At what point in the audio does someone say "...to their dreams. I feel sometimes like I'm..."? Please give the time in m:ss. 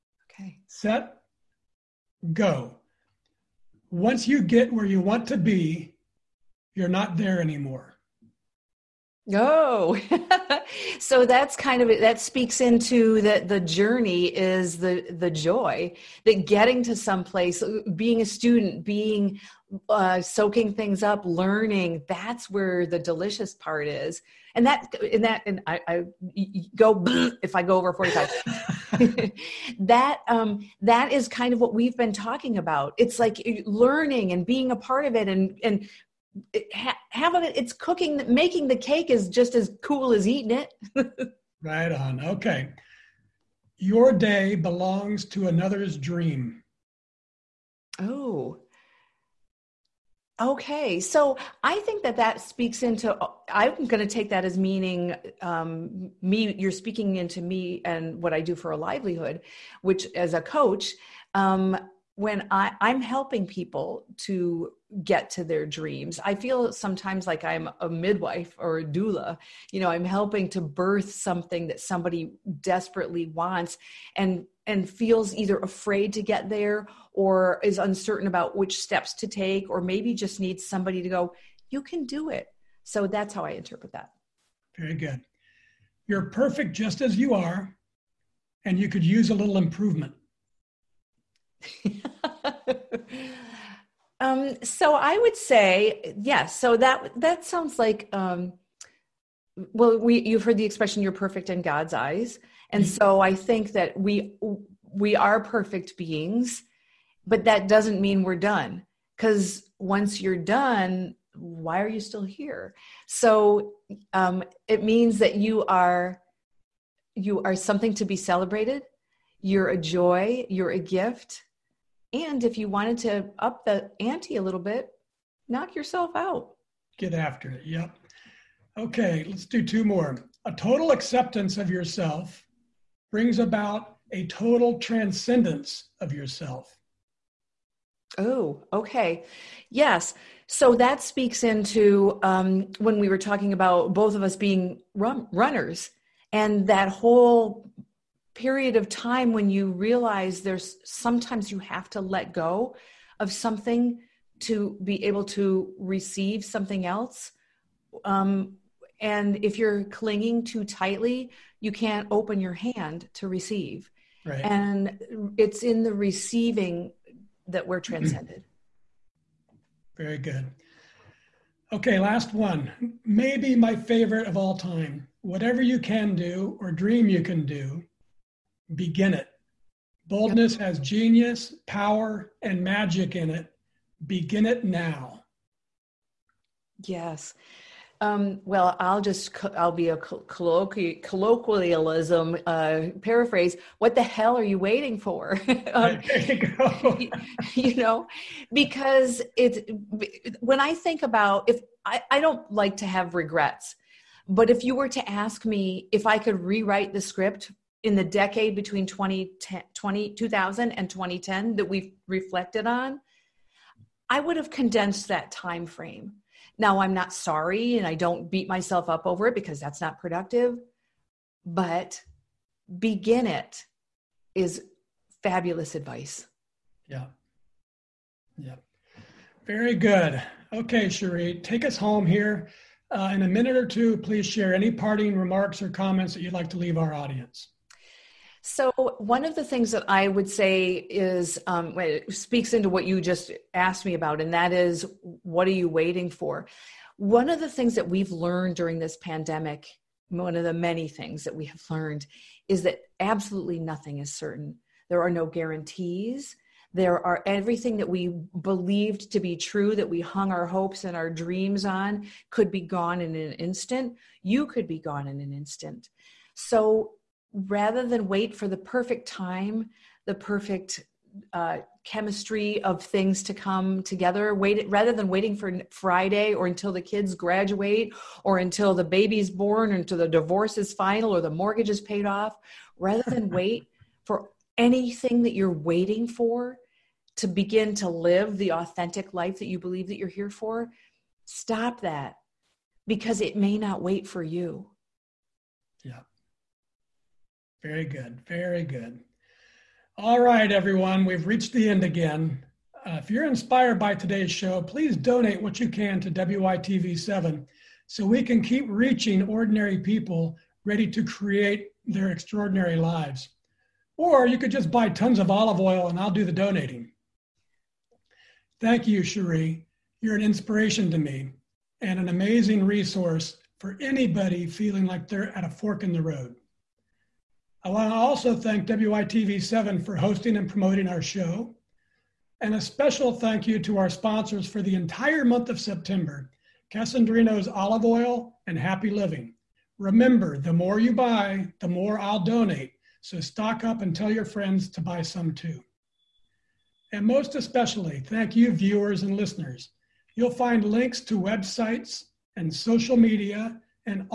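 1:05.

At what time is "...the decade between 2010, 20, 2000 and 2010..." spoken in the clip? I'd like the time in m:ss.
3:27.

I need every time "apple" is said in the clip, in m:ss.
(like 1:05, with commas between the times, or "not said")
not said.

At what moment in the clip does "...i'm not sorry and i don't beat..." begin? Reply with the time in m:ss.
3:36.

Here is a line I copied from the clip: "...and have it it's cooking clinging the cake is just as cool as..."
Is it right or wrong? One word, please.
wrong.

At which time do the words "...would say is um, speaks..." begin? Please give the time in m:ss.
4:00.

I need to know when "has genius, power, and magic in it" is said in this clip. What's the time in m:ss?
3:00.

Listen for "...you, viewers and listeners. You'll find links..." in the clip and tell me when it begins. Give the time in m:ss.
5:48.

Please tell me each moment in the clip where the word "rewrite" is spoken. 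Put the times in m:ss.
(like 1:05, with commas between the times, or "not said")
3:26.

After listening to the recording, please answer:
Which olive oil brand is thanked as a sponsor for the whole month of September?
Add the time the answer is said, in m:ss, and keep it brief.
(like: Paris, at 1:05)
Kasandrino's Olive Oil, at 5:36.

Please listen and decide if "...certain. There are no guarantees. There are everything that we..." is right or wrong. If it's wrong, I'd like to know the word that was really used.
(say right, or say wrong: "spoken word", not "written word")
right.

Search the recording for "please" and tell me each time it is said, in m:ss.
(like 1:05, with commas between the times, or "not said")
3:53, 5:04.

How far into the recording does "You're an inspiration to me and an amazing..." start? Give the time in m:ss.
5:20.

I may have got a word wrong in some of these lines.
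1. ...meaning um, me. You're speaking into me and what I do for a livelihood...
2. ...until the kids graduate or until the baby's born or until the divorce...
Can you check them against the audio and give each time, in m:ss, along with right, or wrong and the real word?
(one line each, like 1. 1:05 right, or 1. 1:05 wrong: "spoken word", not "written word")
1. 0:54 right
2. 4:36 right.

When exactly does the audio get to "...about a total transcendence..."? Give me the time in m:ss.
2:13.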